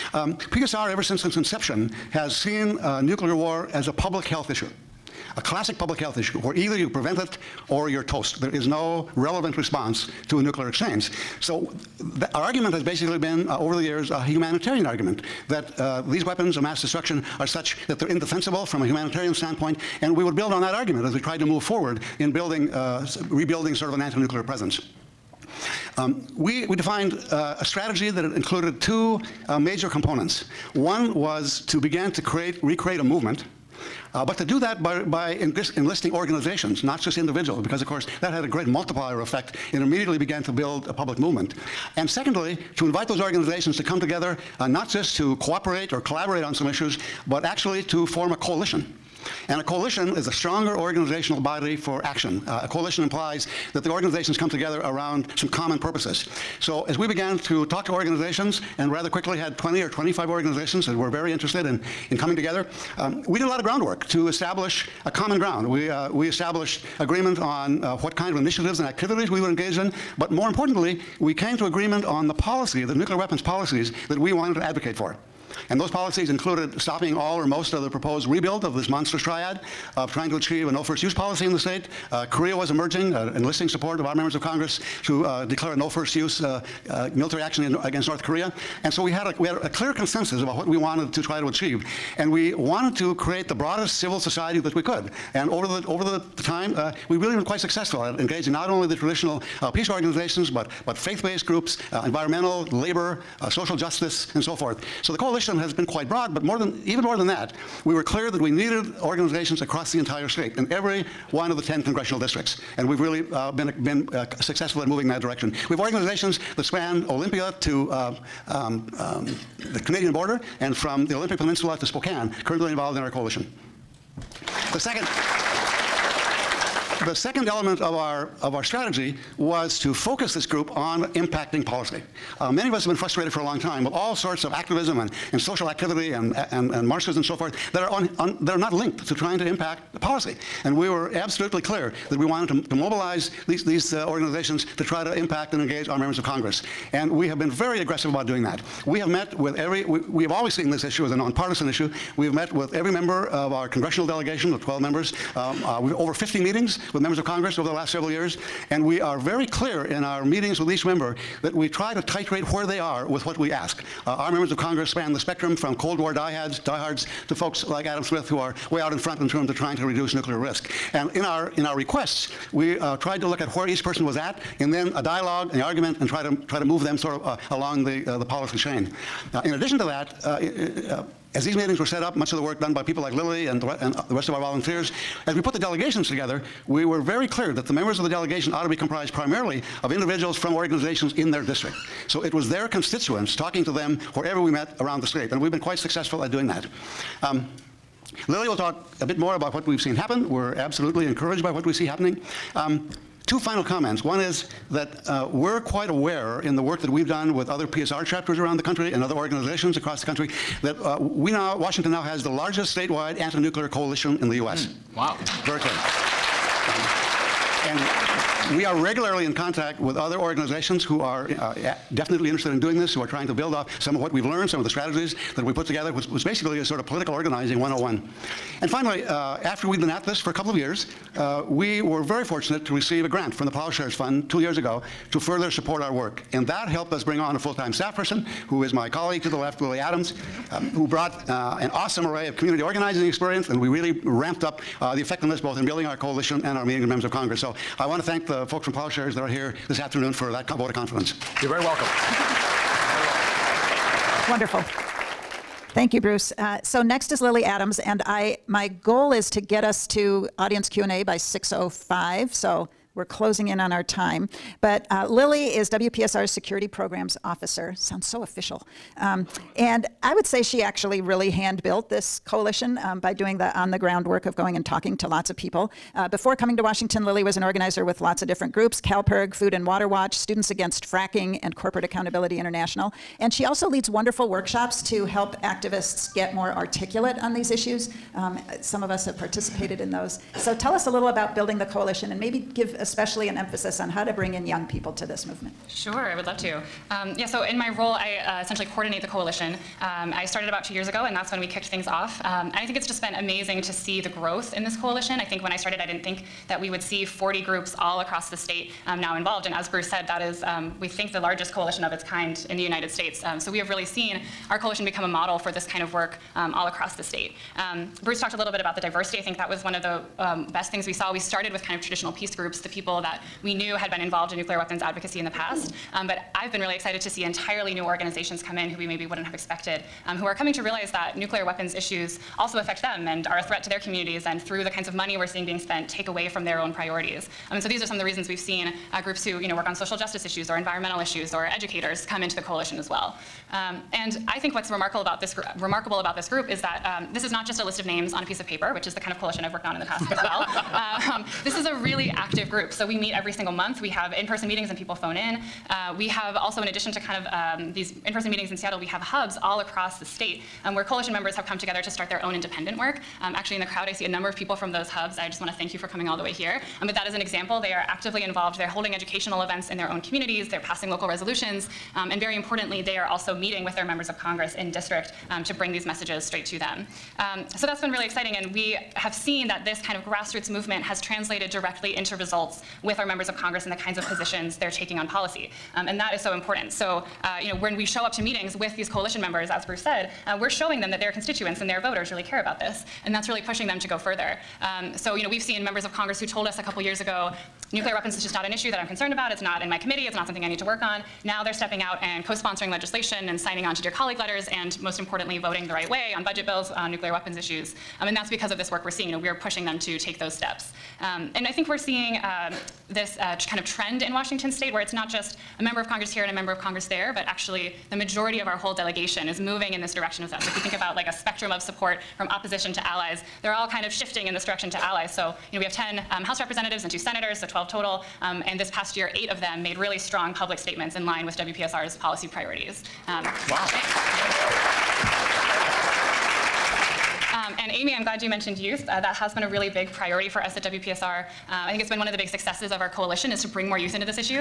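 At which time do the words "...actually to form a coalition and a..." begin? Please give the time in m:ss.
0:47.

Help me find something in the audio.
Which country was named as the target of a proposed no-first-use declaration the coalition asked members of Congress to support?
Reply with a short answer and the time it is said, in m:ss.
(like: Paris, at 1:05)
North Korea, at 1:28.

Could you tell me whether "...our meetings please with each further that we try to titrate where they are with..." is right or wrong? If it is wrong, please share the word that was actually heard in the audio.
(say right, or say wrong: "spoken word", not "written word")
wrong: "member", not "further".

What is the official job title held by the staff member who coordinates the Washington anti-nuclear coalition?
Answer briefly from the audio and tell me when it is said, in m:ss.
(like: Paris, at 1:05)
Security Programs Officer, at 4:26.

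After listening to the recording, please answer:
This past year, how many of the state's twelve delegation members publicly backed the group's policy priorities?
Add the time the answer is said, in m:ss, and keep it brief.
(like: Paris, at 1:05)
8, at 7:09.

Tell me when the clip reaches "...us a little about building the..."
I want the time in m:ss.
4:50.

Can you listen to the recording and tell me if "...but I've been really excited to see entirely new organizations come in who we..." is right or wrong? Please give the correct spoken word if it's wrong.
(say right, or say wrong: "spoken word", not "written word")
right.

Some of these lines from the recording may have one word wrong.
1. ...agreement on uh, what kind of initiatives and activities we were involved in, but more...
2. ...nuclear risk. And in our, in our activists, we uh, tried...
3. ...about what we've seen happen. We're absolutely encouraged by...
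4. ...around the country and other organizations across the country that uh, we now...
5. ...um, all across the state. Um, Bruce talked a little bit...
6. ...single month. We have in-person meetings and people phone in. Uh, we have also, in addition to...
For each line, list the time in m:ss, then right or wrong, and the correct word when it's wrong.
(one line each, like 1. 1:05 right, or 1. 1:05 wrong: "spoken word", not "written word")
1. 1:06 wrong: "engaged", not "involved"
2. 2:50 wrong: "requests", not "activists"
3. 3:19 right
4. 3:28 right
5. 5:16 right
6. 5:53 right.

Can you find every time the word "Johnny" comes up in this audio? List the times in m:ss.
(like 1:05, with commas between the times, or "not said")
not said.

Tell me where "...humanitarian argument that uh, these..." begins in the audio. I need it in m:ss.
0:14.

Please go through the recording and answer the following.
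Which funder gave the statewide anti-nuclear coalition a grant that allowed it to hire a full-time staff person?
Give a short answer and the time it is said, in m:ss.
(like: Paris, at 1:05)
Plowshares Fund, at 3:53.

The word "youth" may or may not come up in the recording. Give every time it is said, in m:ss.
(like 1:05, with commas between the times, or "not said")
7:18, 7:23.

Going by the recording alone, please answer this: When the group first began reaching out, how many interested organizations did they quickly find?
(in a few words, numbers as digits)
20 or 25.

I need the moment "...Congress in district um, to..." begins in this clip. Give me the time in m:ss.
6:14.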